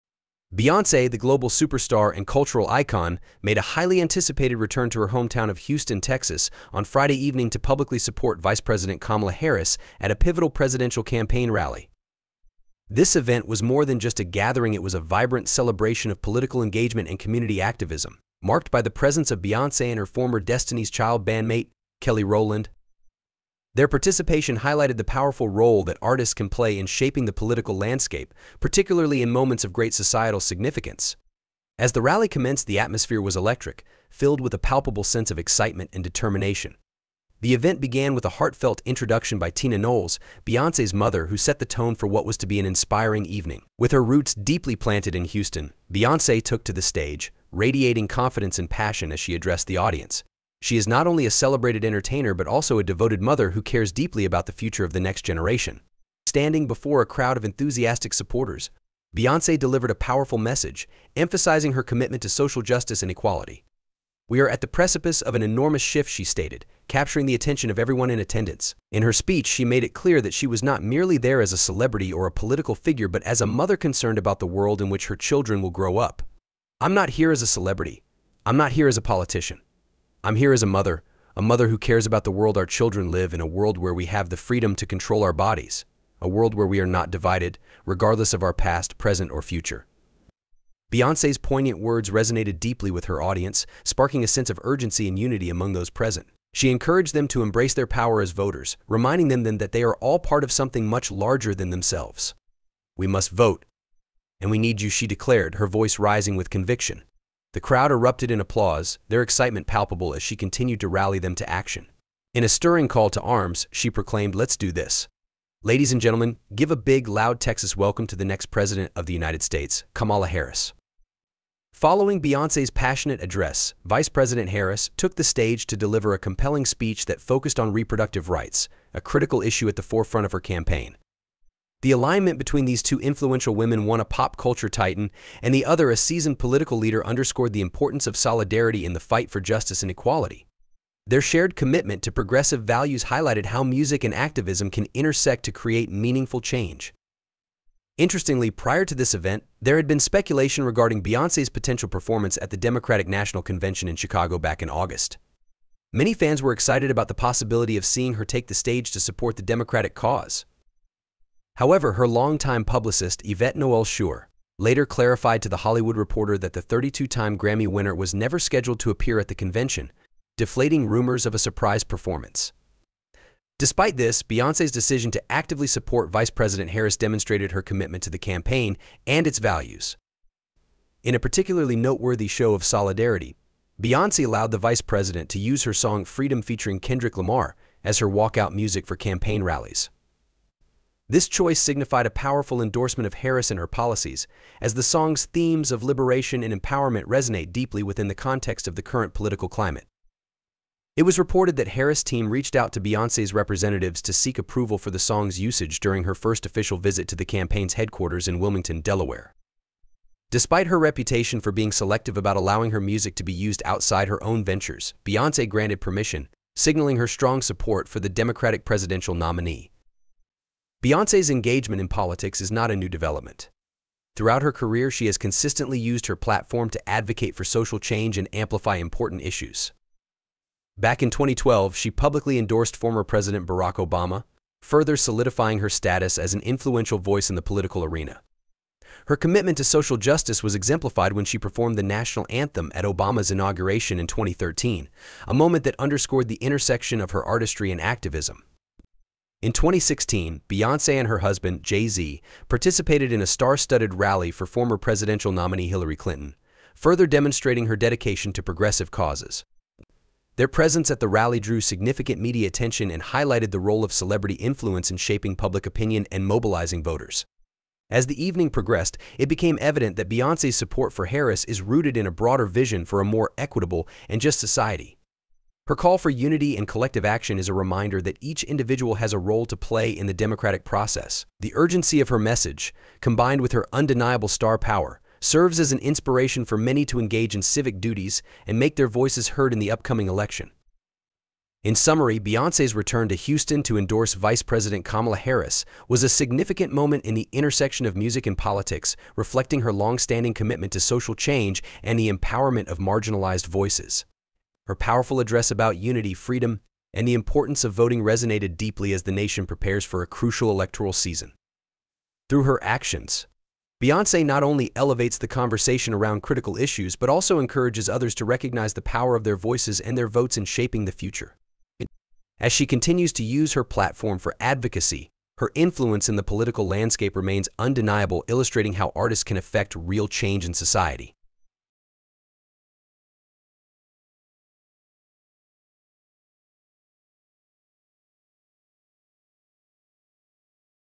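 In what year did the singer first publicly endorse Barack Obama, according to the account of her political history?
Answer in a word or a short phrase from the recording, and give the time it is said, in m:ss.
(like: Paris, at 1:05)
2012, at 3:51.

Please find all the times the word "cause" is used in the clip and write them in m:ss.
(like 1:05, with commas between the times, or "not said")
2:39, 4:18.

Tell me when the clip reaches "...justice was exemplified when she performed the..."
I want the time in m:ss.
3:59.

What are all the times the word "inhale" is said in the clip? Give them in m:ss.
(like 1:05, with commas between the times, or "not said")
not said.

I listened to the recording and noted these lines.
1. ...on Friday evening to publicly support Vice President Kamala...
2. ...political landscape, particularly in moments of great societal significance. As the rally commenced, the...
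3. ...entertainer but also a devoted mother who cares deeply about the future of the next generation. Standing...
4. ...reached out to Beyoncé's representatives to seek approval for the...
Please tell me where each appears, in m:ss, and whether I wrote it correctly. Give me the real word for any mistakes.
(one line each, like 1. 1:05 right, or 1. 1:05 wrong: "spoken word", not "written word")
1. 0:06 right
2. 0:27 right
3. 0:51 right
4. 3:22 right.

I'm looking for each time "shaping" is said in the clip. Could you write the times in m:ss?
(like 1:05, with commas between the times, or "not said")
0:26, 4:24, 5:20.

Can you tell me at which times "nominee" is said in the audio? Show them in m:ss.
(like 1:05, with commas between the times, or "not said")
3:39, 4:15.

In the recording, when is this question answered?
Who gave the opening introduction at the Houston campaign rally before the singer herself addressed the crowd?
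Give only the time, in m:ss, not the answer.
0:39.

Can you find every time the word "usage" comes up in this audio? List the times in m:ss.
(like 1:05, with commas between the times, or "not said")
3:25.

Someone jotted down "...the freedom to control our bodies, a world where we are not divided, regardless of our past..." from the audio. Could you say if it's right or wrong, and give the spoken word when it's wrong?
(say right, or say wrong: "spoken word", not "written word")
right.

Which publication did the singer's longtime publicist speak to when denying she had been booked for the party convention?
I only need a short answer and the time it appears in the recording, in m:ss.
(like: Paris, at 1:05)
The Hollywood Reporter, at 2:45.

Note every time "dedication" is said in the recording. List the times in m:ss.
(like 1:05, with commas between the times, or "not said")
4:17.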